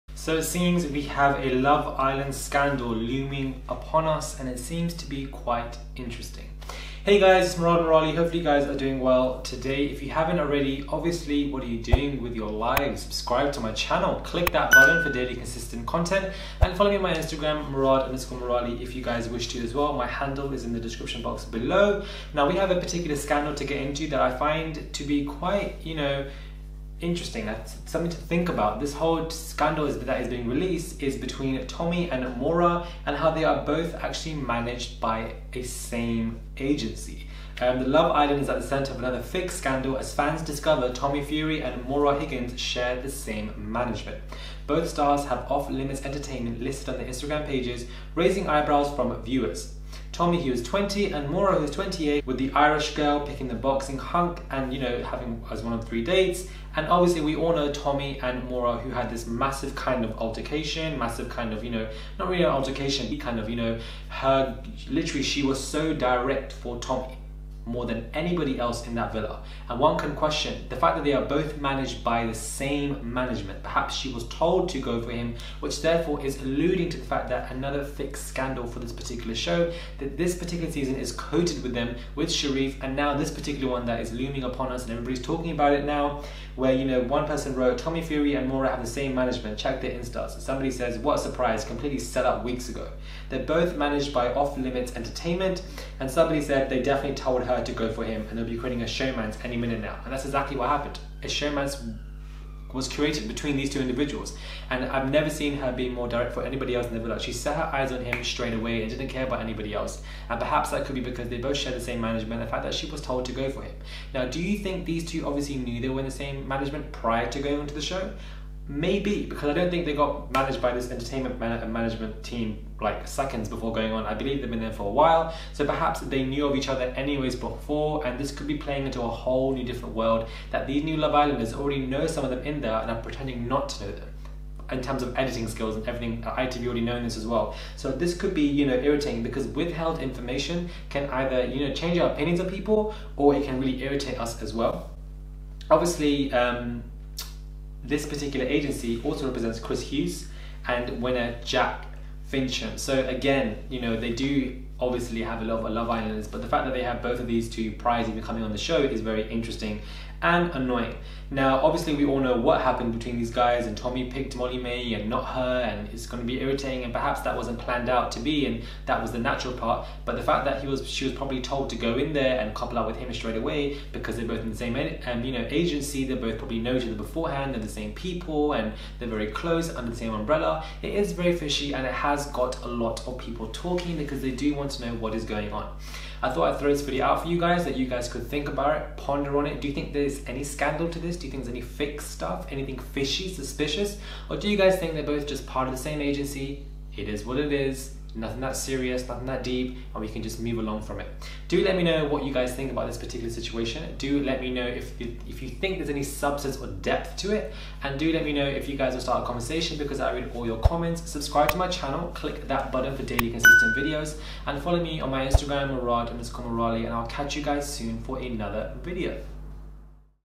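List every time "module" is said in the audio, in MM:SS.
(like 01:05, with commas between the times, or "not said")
not said.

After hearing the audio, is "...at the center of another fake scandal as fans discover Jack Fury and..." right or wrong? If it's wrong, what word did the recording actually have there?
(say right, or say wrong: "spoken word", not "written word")
wrong: "Tommy", not "Jack".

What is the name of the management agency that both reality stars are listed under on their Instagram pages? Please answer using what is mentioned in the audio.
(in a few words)
Off Limits Entertainment.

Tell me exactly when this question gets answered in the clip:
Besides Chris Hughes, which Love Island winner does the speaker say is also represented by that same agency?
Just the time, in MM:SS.
02:31.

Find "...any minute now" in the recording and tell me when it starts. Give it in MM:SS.
01:39.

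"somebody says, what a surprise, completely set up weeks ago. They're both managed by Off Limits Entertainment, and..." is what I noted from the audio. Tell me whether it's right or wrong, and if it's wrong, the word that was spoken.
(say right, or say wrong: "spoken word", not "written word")
right.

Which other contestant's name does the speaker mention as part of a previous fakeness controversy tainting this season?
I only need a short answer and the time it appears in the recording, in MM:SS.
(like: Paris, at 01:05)
Sherif, at 01:22.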